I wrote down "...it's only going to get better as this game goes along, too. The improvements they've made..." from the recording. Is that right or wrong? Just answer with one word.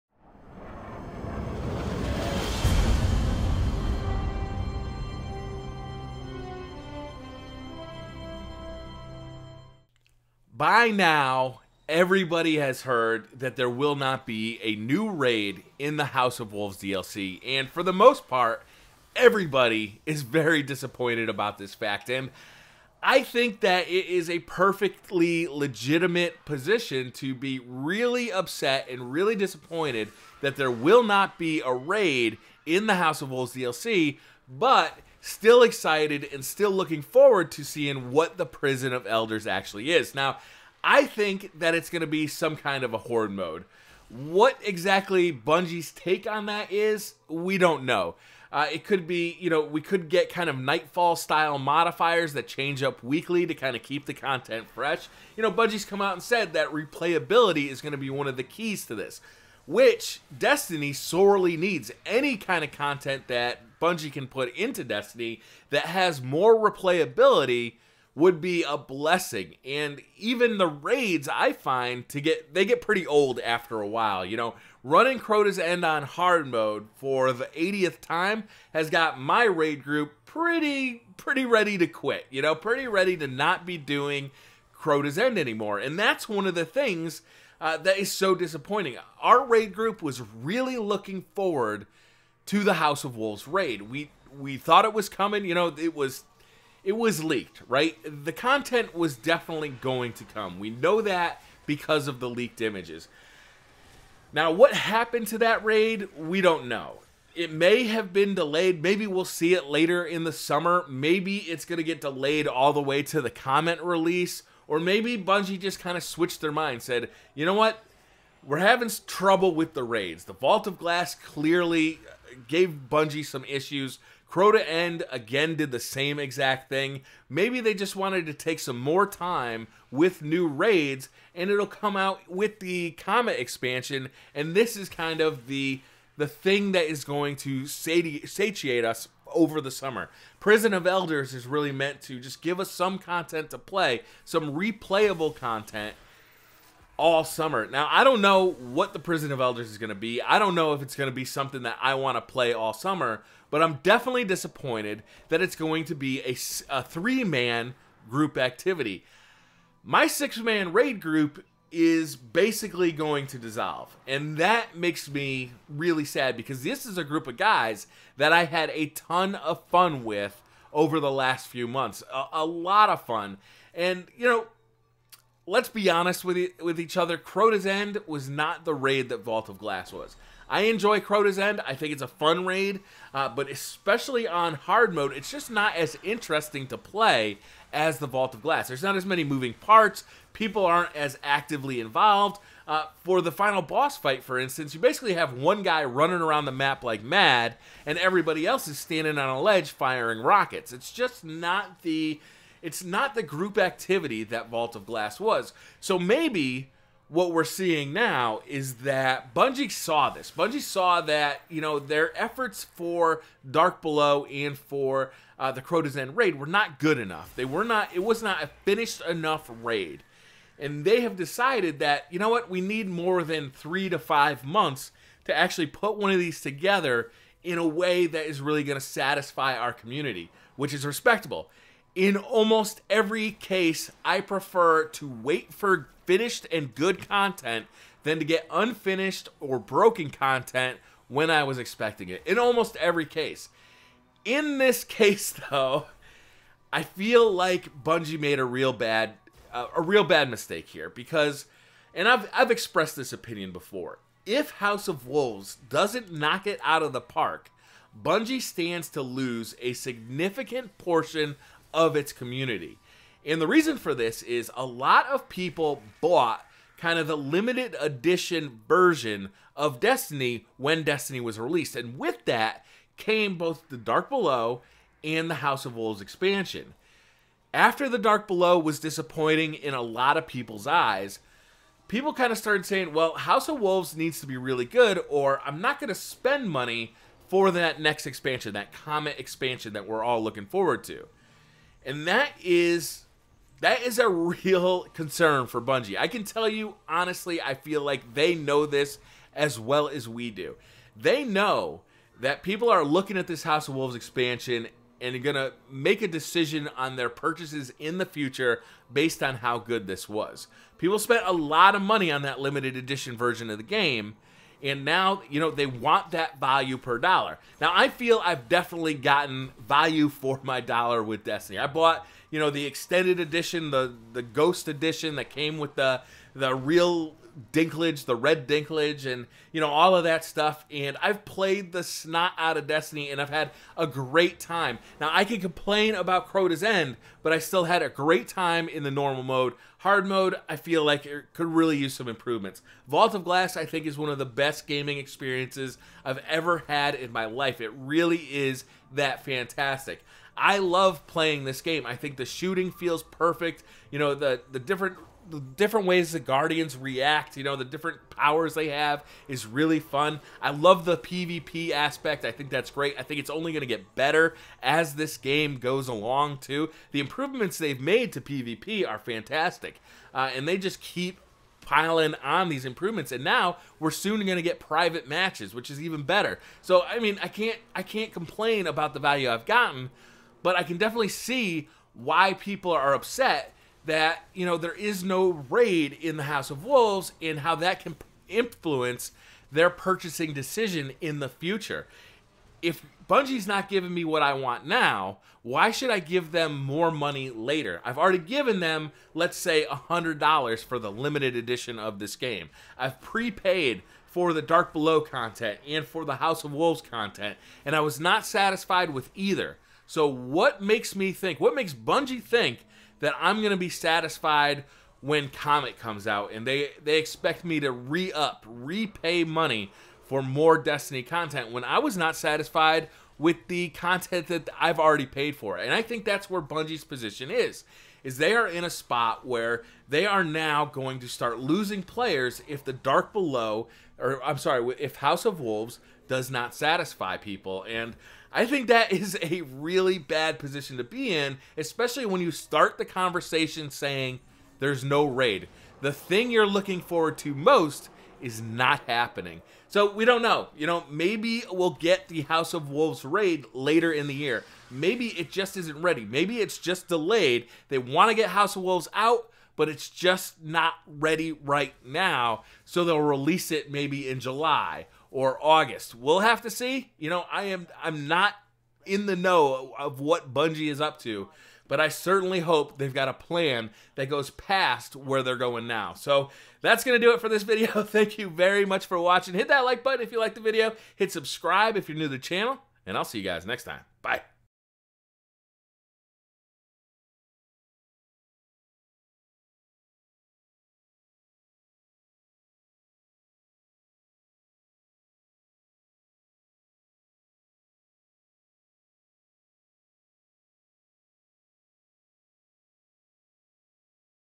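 right.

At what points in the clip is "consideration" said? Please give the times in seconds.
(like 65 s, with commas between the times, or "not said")
not said.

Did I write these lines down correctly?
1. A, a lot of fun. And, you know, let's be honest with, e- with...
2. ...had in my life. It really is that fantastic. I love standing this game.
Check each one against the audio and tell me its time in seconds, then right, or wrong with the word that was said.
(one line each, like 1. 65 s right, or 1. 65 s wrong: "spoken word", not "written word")
1. 172 s right
2. 346 s wrong: "playing", not "standing".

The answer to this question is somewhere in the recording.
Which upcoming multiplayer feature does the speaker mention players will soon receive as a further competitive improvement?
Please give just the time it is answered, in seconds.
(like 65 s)
374 s.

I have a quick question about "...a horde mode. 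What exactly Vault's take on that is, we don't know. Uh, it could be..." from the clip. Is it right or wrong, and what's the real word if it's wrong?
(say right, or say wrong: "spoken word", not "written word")
wrong: "Bungie", not "Vault".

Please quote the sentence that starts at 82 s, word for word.
You know, pretty ready to not be doing Crota's End anymore.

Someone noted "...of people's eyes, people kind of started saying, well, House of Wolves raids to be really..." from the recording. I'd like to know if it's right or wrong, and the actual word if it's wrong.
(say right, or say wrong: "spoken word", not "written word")
wrong: "needs", not "raids".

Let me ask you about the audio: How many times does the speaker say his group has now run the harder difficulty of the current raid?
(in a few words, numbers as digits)
80.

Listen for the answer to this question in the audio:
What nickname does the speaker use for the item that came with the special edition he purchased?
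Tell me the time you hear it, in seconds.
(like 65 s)
328 s.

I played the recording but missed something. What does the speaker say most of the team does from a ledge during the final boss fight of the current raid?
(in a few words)
firing rockets.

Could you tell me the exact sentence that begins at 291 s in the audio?
And that is that is a real concern for Bungie.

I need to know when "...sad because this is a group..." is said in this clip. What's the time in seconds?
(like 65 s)
166 s.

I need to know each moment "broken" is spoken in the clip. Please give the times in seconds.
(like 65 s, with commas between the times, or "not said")
239 s.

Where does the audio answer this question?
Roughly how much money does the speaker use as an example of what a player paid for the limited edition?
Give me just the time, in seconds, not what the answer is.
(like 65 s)
399 s.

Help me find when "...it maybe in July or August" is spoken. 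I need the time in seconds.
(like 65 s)
463 s.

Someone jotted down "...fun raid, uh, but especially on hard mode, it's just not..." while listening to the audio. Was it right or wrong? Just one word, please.
right.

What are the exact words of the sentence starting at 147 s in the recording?
Now, I don't know what the Prison of Elders is going to be.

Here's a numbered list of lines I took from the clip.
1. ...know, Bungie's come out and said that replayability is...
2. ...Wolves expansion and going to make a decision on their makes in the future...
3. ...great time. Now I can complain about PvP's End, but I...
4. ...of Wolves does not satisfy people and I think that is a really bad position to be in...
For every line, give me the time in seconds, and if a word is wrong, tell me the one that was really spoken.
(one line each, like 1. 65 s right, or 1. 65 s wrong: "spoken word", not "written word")
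1. 55 s right
2. 303 s wrong: "purchases", not "makes"
3. 333 s wrong: "Crota", not "PvP"
4. 435 s right.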